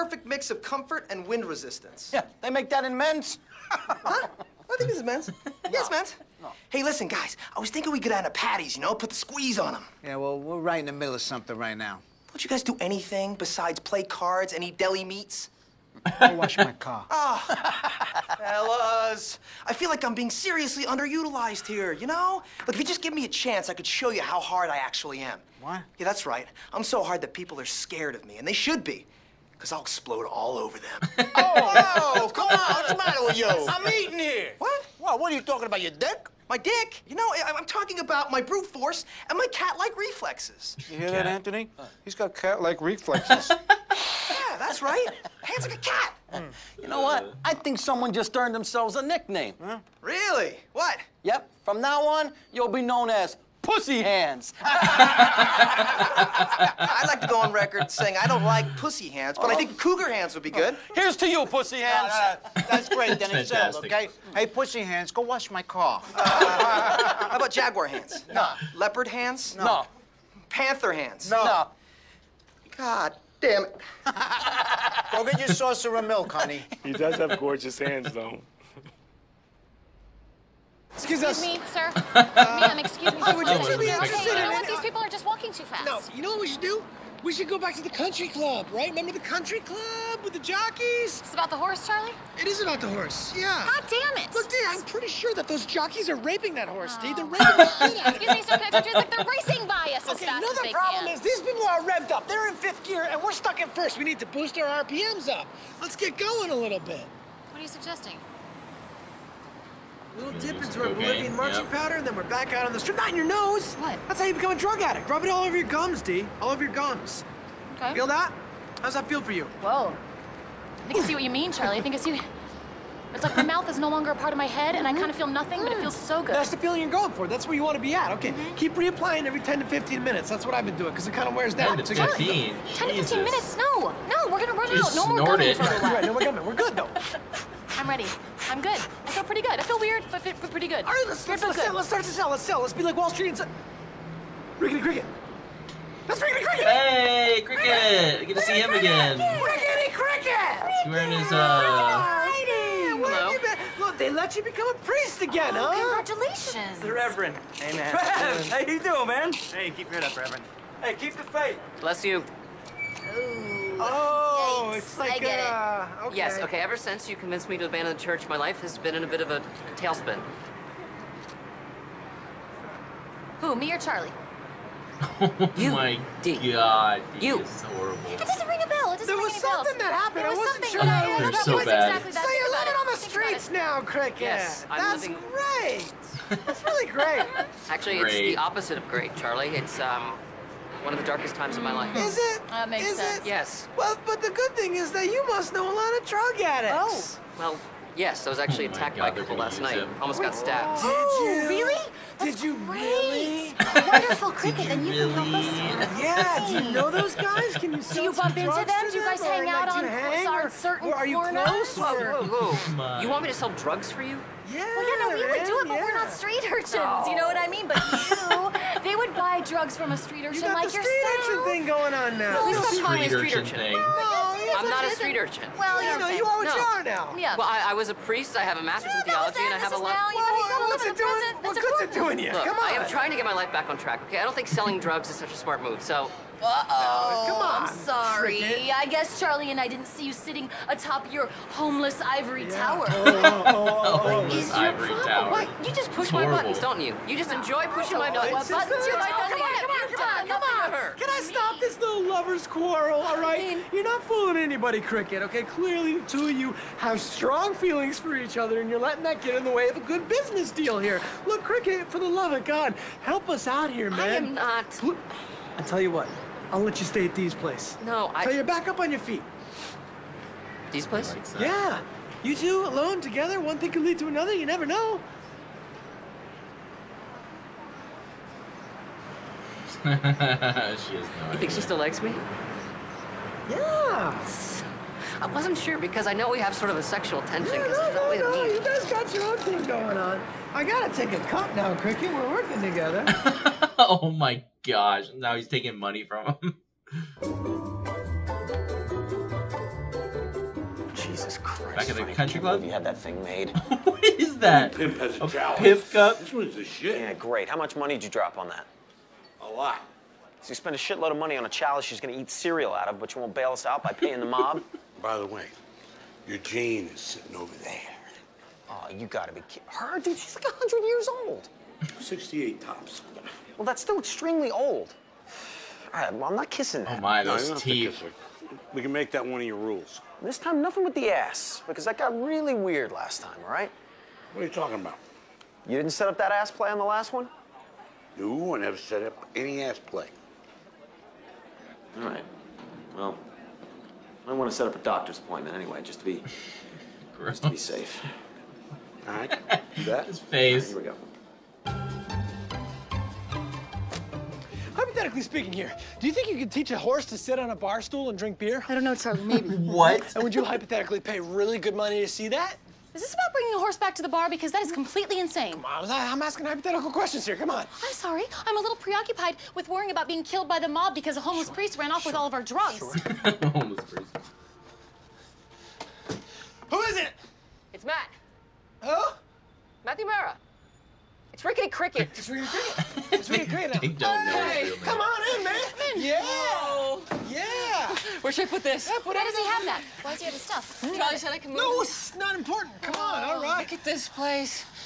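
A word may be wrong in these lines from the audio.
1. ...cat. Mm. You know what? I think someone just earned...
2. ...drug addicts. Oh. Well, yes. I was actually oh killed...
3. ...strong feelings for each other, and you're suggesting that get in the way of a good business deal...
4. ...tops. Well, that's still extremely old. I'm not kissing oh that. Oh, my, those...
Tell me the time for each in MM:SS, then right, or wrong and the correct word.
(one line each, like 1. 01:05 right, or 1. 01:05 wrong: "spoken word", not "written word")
1. 00:45 right
2. 03:16 wrong: "attacked", not "killed"
3. 04:17 wrong: "letting", not "suggesting"
4. 05:22 right.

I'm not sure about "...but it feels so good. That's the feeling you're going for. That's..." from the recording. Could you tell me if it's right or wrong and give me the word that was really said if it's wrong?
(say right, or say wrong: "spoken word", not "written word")
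right.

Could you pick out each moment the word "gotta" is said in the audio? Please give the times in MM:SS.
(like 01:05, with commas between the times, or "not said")
04:50, 05:19.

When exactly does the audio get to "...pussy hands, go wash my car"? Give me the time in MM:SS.
01:04.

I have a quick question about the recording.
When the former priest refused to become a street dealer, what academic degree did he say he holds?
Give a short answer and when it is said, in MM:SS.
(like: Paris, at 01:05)
master's in theology, at 03:48.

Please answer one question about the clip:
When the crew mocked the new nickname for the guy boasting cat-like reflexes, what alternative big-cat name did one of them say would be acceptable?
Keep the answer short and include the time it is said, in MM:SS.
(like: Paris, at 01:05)
cougar hands, at 00:59.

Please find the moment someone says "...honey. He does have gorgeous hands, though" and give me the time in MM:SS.
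01:16.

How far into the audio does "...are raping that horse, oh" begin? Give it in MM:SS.
01:36.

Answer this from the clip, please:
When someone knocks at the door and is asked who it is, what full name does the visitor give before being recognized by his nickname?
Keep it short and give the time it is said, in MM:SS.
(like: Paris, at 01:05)
Matthew Mara, at 06:19.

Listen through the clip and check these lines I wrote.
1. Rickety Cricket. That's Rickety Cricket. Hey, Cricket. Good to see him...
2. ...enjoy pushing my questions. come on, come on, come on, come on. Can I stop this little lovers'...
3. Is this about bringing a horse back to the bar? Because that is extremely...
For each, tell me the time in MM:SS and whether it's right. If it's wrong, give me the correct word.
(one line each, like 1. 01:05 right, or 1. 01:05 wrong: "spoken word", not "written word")
1. 02:24 right
2. 04:07 wrong: "buttons", not "questions"
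3. 06:02 wrong: "completely", not "extremely".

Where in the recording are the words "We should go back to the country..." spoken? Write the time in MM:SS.
01:27.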